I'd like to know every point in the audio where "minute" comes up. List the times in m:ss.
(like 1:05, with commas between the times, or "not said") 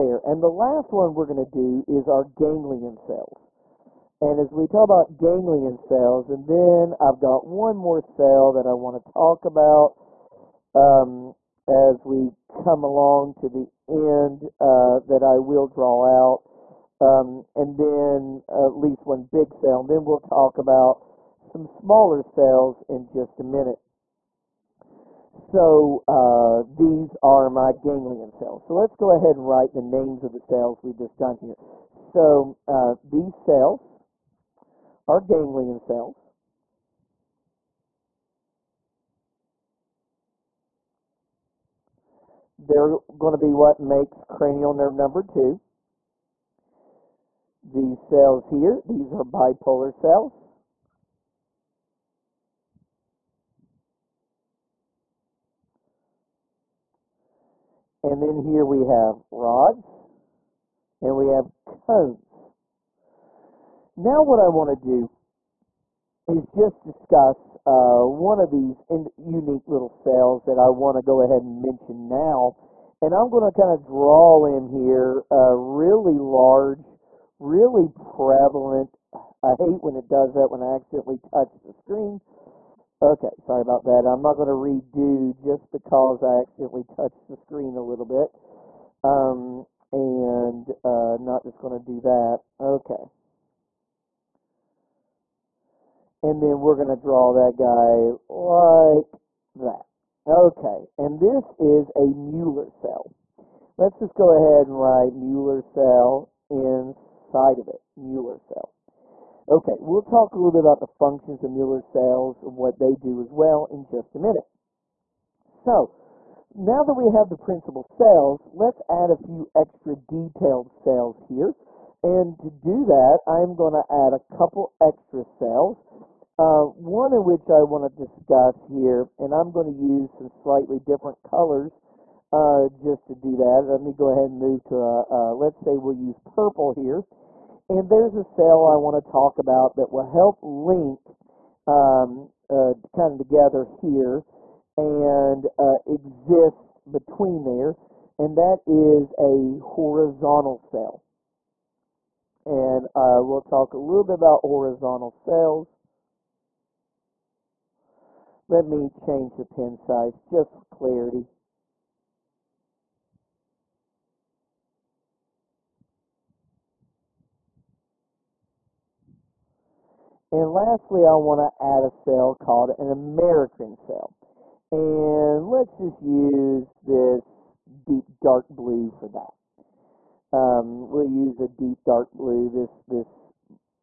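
0:23, 1:54.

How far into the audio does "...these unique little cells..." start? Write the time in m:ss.
1:08.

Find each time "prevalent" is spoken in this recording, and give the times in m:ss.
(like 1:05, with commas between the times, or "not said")
1:17.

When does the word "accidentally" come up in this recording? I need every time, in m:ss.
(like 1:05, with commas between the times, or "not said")
1:20, 1:26.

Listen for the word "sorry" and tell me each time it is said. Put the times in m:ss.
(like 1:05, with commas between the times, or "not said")
1:23.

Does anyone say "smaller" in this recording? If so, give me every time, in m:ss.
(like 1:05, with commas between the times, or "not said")
0:21.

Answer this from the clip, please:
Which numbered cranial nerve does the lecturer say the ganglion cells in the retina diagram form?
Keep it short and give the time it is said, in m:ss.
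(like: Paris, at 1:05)
2, at 0:44.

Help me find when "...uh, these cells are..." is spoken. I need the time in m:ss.
0:32.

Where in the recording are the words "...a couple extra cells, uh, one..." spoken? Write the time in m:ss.
2:04.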